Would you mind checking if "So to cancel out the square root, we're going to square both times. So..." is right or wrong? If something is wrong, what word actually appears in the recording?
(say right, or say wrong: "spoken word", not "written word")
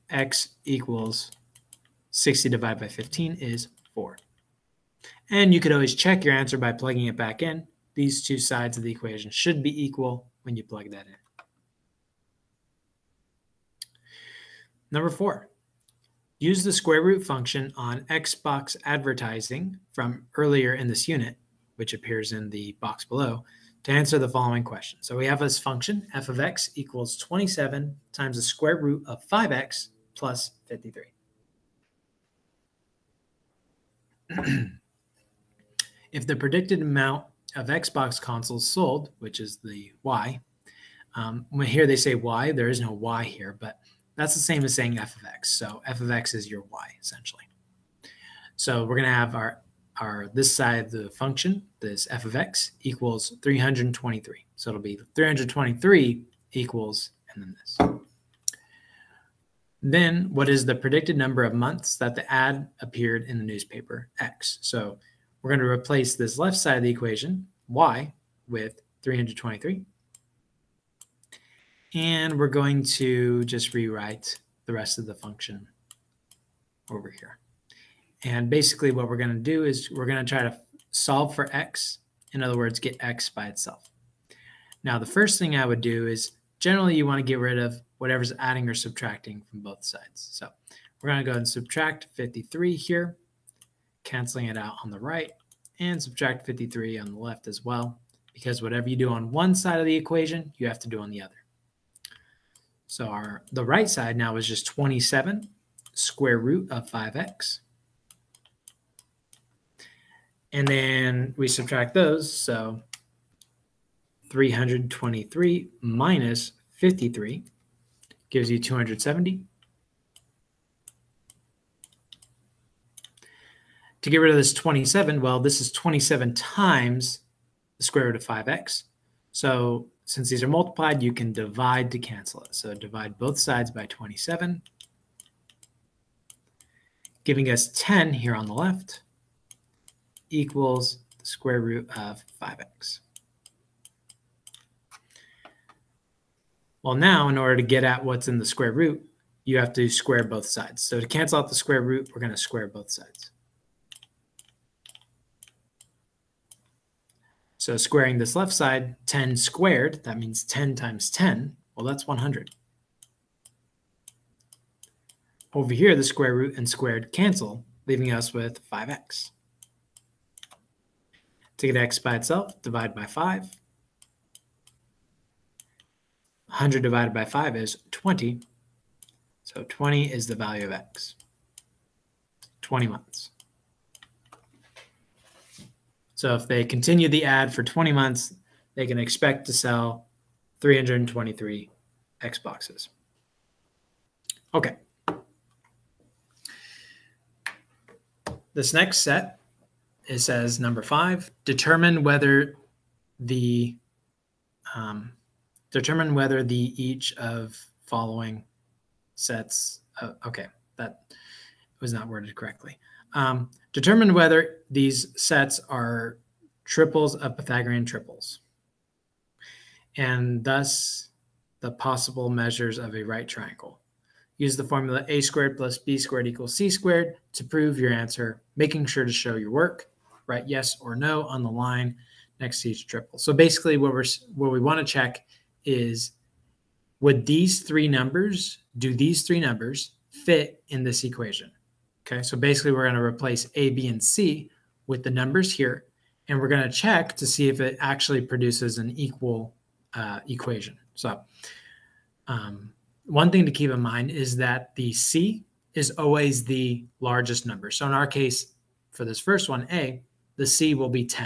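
wrong: "sides", not "times".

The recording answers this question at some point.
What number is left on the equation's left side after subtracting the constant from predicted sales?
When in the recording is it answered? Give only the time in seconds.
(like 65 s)
118 s.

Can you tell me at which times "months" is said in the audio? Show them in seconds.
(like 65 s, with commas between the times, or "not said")
61 s, 182 s, 187 s.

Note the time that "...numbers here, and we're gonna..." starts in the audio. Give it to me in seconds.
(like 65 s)
245 s.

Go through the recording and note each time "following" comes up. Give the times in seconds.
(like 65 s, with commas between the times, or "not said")
24 s, 207 s.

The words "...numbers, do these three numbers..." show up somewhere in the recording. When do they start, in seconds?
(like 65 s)
237 s.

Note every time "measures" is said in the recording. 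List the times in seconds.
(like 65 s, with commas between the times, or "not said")
222 s.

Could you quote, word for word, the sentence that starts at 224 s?
Use the formula a squared plus b squared equals c squared to prove your answer, making sure to show your work.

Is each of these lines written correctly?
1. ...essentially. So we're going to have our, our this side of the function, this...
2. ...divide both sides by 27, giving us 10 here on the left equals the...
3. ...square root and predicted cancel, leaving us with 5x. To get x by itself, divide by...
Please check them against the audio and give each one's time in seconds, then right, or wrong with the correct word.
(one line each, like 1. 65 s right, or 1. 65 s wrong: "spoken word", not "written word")
1. 46 s right
2. 132 s right
3. 166 s wrong: "squared", not "predicted".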